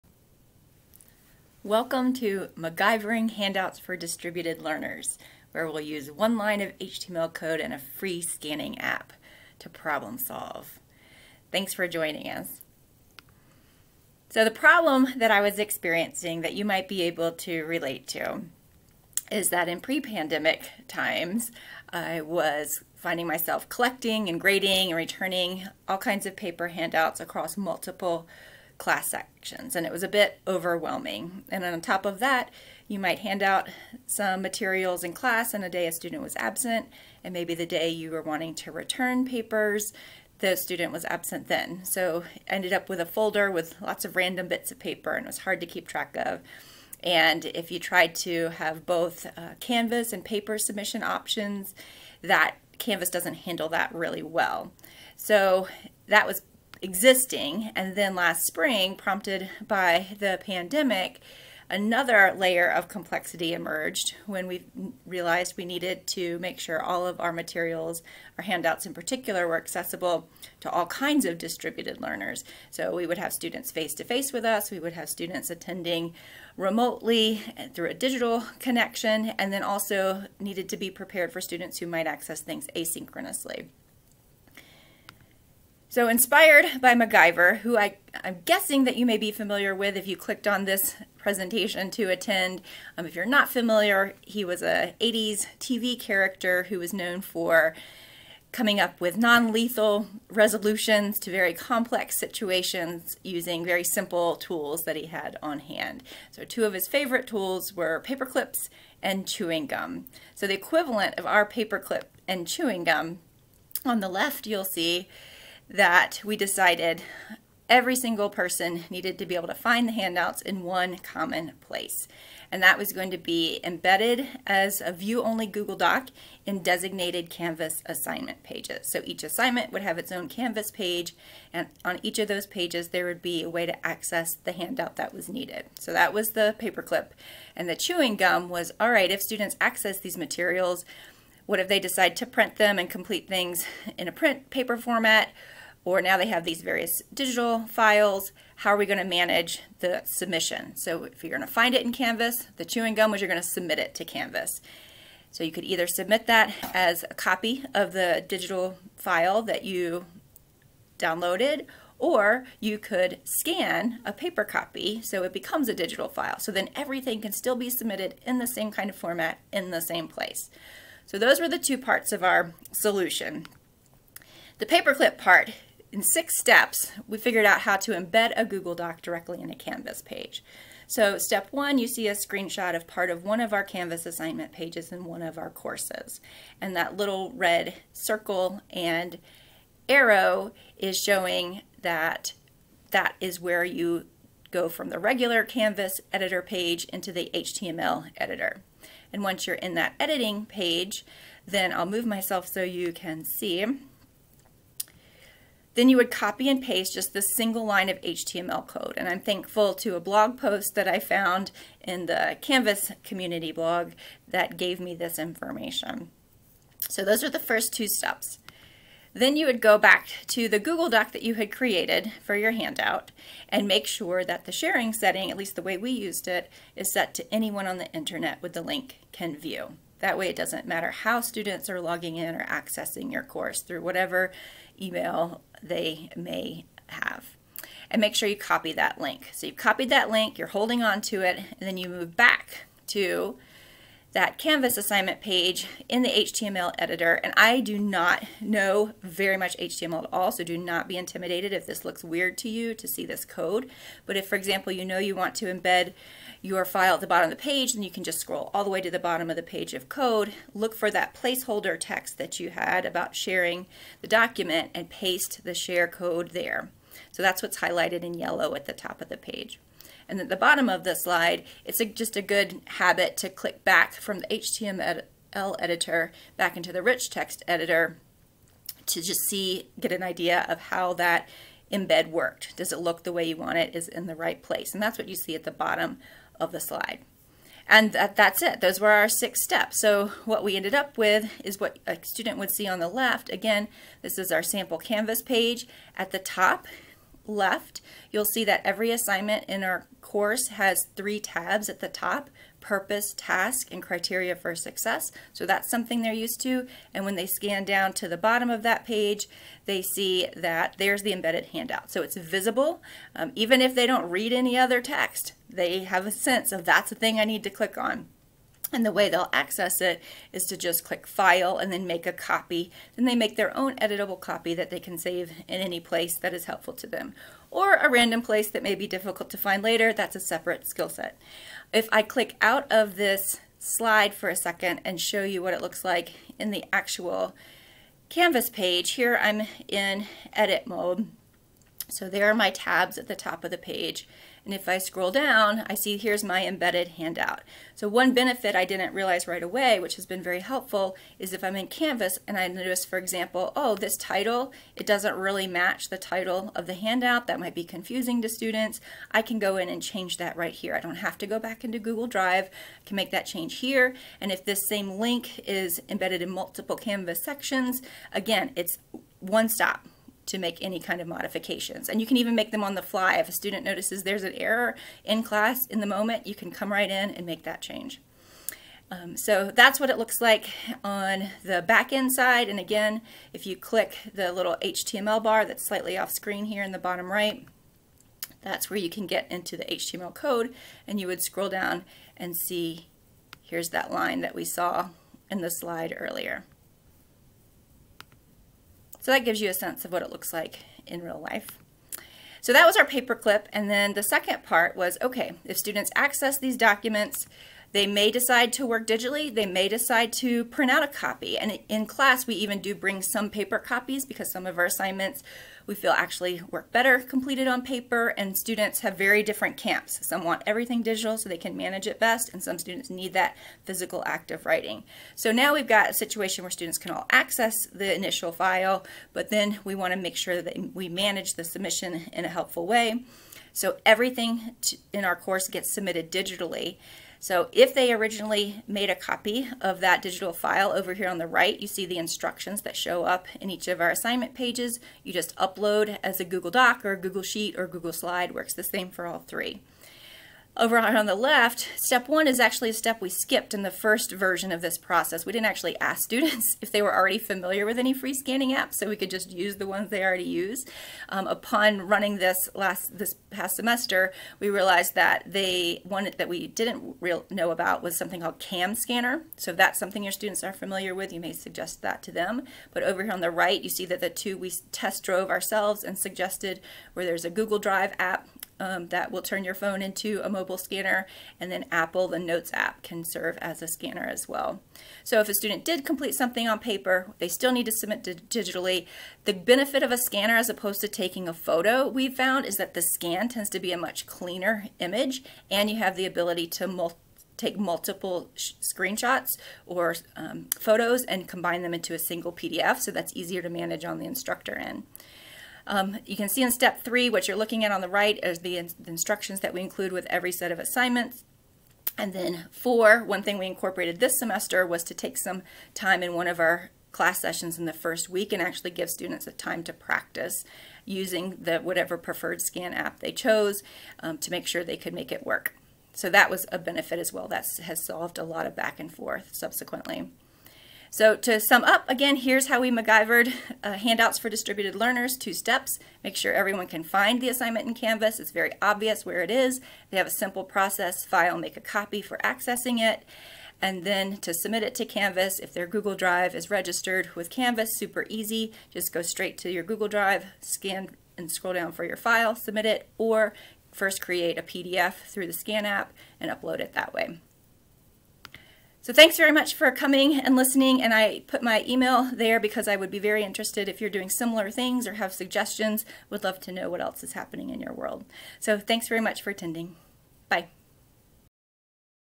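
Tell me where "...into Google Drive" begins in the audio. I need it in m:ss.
6:01.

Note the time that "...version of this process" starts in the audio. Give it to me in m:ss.
7:34.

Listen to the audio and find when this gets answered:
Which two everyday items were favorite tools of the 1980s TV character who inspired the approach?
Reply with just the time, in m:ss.
1:47.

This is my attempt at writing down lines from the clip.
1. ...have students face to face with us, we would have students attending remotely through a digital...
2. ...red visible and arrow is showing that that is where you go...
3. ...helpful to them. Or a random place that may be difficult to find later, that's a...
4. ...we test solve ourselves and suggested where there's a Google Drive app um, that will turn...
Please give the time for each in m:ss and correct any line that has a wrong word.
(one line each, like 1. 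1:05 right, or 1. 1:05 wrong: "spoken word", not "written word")
1. 1:13 right
2. 3:07 wrong: "circle", not "visible"
3. 5:26 right
4. 7:54 wrong: "drove", not "solve".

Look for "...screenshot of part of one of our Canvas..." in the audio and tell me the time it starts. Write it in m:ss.
3:02.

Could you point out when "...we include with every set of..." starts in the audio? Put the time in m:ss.
8:29.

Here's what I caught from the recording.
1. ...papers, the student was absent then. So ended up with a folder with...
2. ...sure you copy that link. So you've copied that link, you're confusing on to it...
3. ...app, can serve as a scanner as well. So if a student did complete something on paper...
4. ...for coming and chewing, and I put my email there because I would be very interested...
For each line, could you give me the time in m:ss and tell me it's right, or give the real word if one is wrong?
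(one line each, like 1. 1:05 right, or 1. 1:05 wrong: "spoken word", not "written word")
1. 0:39 right
2. 3:58 wrong: "holding", not "confusing"
3. 8:02 right
4. 9:19 wrong: "listening", not "chewing".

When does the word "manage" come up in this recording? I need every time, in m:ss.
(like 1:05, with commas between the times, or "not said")
2:29, 7:01, 7:10, 8:23.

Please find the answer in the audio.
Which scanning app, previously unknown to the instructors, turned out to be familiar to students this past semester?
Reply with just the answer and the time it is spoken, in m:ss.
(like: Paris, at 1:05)
CamScanner, at 7:48.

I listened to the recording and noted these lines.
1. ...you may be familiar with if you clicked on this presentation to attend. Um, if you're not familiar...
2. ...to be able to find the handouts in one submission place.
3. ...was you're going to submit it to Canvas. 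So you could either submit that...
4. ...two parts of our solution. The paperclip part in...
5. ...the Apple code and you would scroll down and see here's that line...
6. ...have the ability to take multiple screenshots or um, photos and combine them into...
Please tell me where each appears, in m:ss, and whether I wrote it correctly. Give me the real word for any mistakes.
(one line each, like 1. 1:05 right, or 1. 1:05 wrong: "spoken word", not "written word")
1. 1:28 right
2. 1:59 wrong: "common", not "submission"
3. 2:33 right
4. 2:51 right
5. 6:29 wrong: "HTML", not "Apple"
6. 8:15 right.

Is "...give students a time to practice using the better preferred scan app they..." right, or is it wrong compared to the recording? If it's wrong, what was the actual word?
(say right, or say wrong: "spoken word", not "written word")
wrong: "whatever", not "better".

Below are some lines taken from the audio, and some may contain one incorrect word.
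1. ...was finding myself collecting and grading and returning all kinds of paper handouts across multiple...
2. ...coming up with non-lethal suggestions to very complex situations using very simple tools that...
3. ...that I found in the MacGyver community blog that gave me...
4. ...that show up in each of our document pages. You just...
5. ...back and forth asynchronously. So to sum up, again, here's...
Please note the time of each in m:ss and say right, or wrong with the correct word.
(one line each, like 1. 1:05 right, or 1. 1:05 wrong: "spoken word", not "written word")
1. 0:22 right
2. 1:38 wrong: "resolutions", not "suggestions"
3. 3:30 wrong: "Canvas", not "MacGyver"
4. 7:22 wrong: "assignment", not "document"
5. 8:48 wrong: "subsequently", not "asynchronously".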